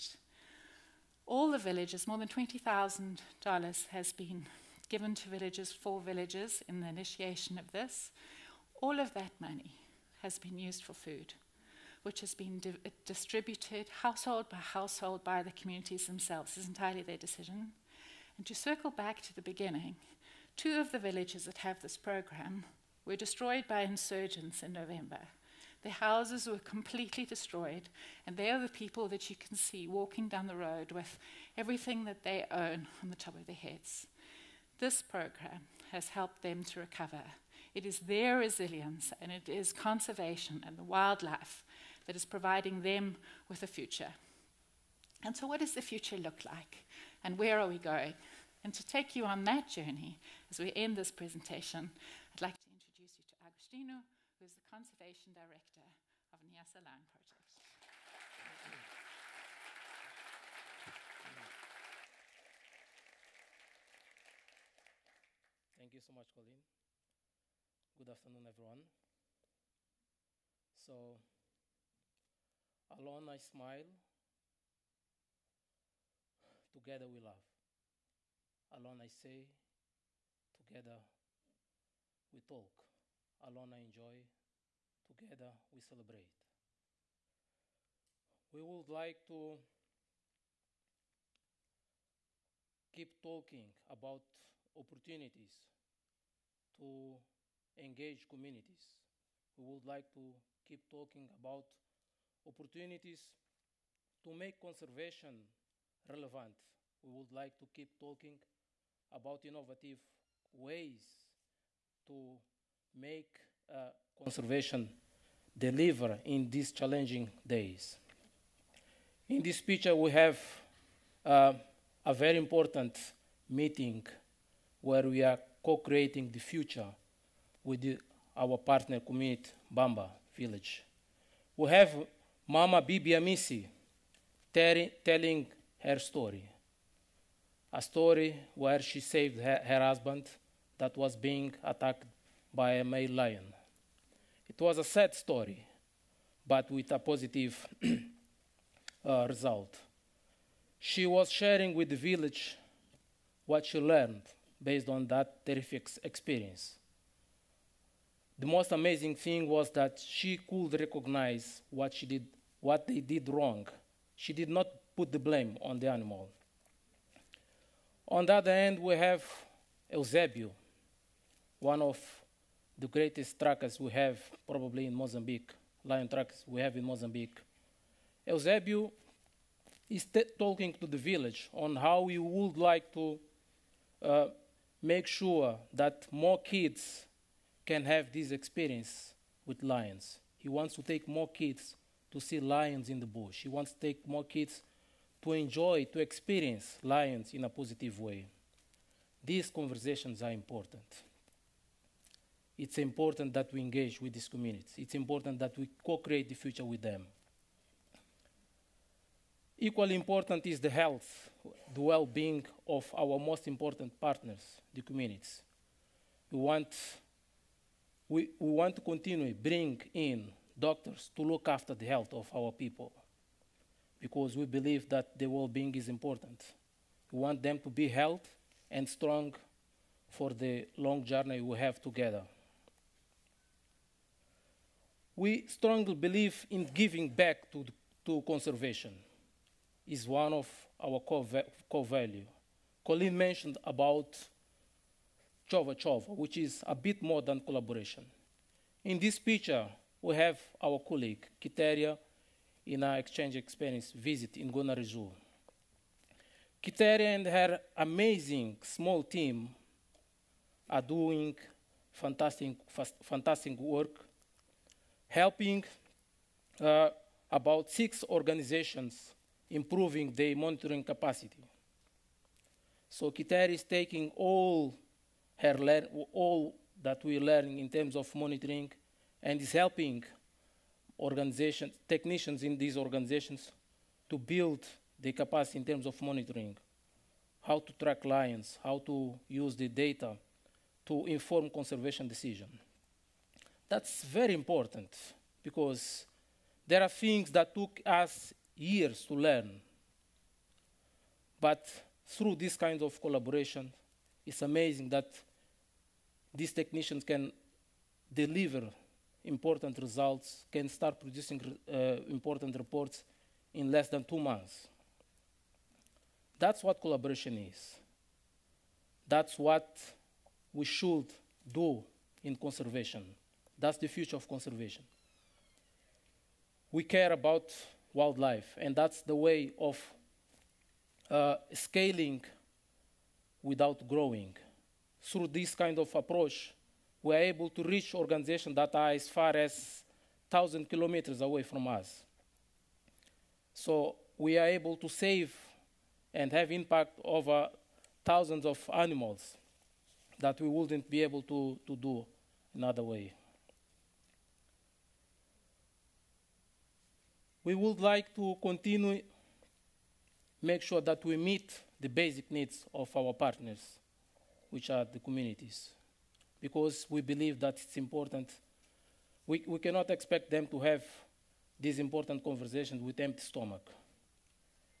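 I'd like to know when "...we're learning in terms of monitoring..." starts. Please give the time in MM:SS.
04:37.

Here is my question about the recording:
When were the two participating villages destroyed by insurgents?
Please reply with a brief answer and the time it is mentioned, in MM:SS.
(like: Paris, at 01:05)
November, at 00:24.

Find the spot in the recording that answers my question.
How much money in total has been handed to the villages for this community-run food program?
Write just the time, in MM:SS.
00:02.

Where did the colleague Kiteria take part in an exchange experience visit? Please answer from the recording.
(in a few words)
Gonarezhou.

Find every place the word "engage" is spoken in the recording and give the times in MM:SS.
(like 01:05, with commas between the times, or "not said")
01:37, 03:23.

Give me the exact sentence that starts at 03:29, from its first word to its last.
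Equally important is the health, the well being of our most important partners, the communities.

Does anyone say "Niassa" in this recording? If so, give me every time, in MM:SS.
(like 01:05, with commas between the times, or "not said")
00:56.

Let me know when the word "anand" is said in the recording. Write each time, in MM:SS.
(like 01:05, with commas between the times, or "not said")
not said.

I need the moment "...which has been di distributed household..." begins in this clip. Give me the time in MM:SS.
00:12.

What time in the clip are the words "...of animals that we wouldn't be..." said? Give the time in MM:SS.
05:48.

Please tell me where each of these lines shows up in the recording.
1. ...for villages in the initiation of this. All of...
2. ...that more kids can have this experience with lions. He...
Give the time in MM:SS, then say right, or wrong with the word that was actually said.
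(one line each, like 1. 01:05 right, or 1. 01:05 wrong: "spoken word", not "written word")
1. 00:05 right
2. 03:05 right.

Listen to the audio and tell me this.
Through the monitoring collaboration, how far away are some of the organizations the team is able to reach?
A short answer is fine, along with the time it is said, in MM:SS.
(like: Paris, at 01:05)
1,000 kilometers, at 05:40.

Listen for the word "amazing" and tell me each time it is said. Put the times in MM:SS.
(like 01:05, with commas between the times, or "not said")
02:38, 04:17, 05:04.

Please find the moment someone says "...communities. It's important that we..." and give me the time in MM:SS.
03:24.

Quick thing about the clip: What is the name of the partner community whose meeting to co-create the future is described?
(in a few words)
Mbamba Village.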